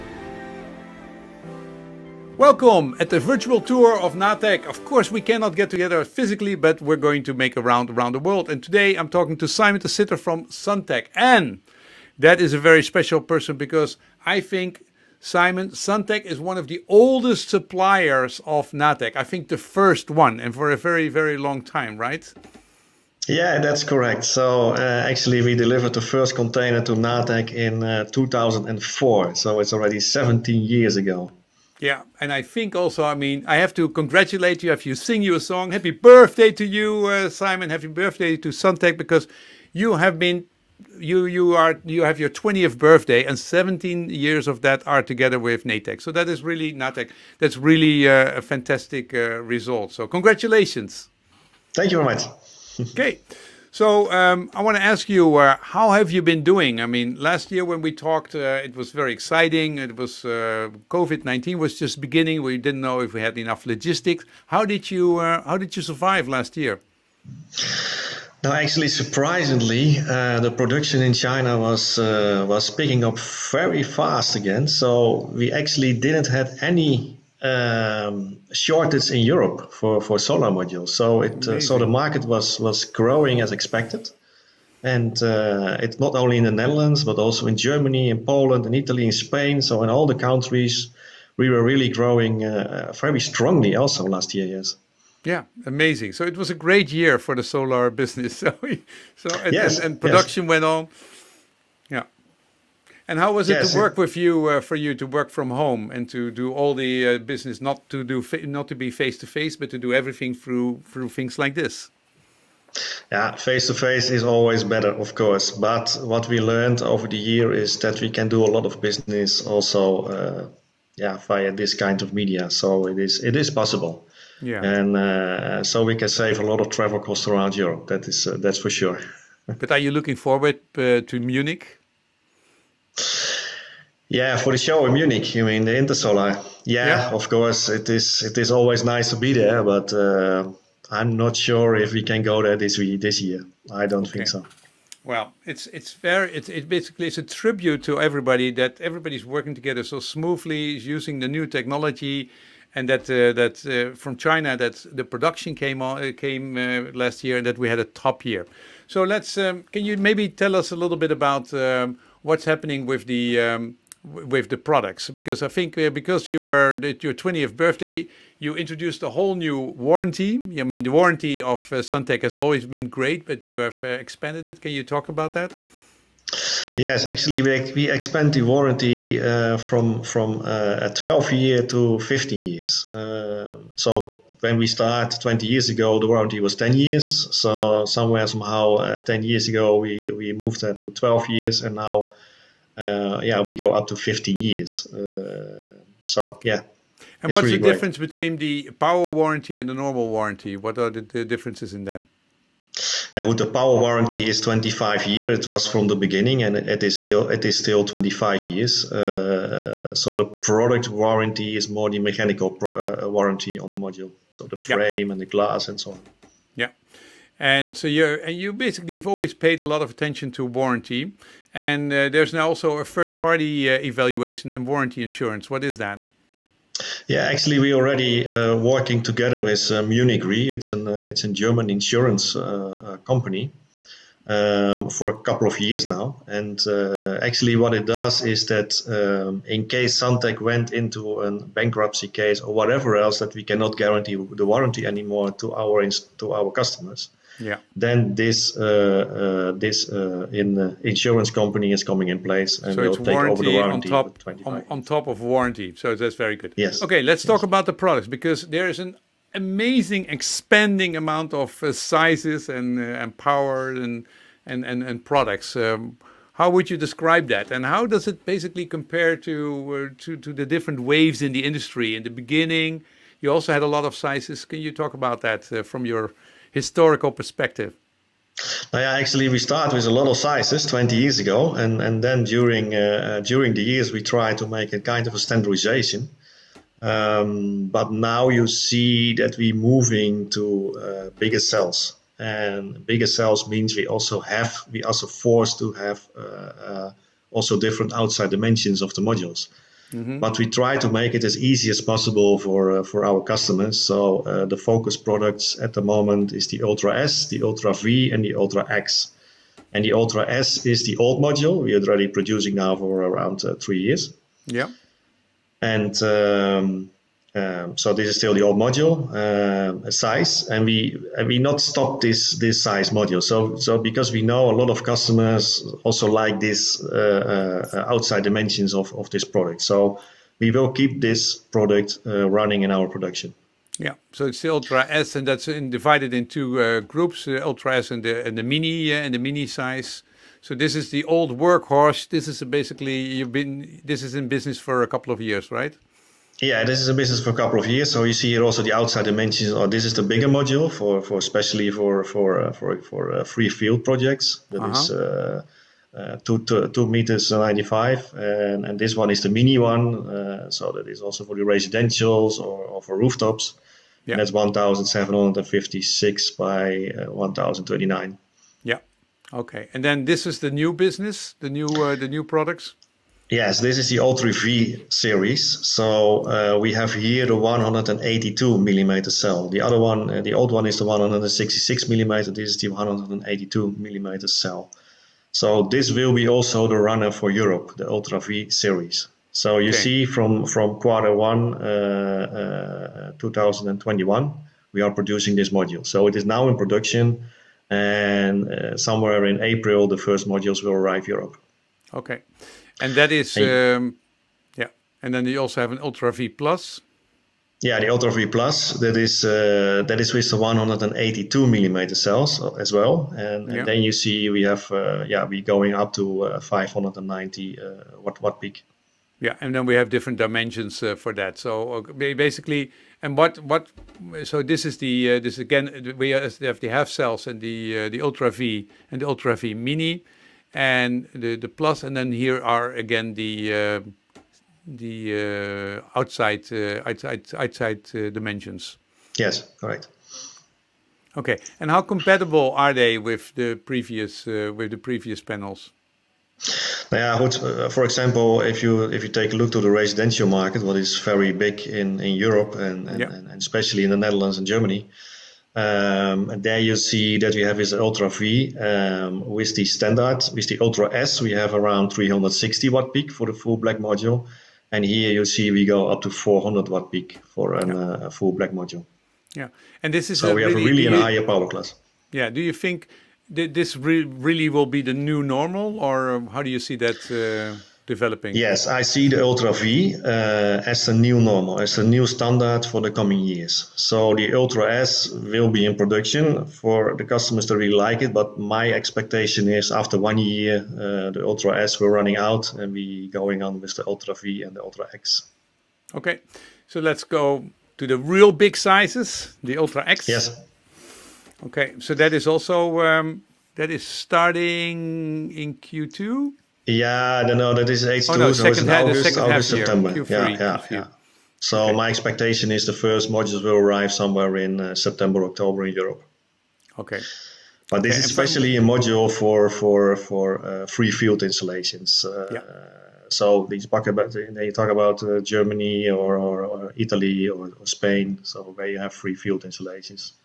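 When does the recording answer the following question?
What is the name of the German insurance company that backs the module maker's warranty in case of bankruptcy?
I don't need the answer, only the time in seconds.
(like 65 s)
229 s.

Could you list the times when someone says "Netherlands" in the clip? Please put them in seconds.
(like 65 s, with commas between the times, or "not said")
86 s, 453 s.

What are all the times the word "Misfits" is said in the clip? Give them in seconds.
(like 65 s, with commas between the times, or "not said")
not said.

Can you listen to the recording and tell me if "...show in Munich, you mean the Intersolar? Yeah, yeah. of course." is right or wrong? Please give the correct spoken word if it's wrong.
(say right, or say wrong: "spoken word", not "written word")
right.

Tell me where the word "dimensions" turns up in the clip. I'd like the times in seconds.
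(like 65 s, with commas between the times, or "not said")
298 s, 328 s, 349 s, 420 s, 438 s.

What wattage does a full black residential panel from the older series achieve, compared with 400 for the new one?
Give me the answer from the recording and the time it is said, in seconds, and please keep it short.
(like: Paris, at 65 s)
360 watt peak, at 461 s.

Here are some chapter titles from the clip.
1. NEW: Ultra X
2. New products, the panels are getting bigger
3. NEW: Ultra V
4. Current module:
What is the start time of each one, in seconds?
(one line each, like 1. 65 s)
1. 495 s
2. 249 s
3. 367 s
4. 309 s.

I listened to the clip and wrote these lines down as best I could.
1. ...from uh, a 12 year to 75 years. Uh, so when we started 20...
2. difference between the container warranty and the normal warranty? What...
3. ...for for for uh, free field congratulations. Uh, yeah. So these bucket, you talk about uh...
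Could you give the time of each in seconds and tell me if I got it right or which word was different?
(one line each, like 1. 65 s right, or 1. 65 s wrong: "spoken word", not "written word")
1. 180 s wrong: "15", not "75"
2. 197 s wrong: "power", not "container"
3. 519 s wrong: "installations", not "congratulations".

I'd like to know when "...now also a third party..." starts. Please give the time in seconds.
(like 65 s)
222 s.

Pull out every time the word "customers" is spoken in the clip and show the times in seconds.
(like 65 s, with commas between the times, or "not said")
246 s, 303 s, 324 s, 487 s.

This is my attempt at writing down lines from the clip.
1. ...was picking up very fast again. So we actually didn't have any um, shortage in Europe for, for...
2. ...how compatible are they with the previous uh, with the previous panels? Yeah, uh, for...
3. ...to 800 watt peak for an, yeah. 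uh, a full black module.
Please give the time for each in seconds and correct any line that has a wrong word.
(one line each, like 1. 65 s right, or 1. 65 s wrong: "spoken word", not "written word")
1. 72 s right
2. 441 s right
3. 466 s wrong: "400", not "800".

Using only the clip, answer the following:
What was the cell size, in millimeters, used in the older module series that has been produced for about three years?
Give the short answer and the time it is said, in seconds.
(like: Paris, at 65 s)
166 millimeter, at 380 s.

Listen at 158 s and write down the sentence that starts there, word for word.
So let's um, can you maybe tell us a little bit about.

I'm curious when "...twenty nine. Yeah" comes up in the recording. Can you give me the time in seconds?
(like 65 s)
367 s.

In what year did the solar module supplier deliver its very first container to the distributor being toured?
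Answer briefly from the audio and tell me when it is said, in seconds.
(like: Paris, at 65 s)
2004, at 28 s.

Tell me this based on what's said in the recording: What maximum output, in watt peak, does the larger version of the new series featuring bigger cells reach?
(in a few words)
590 watt peak.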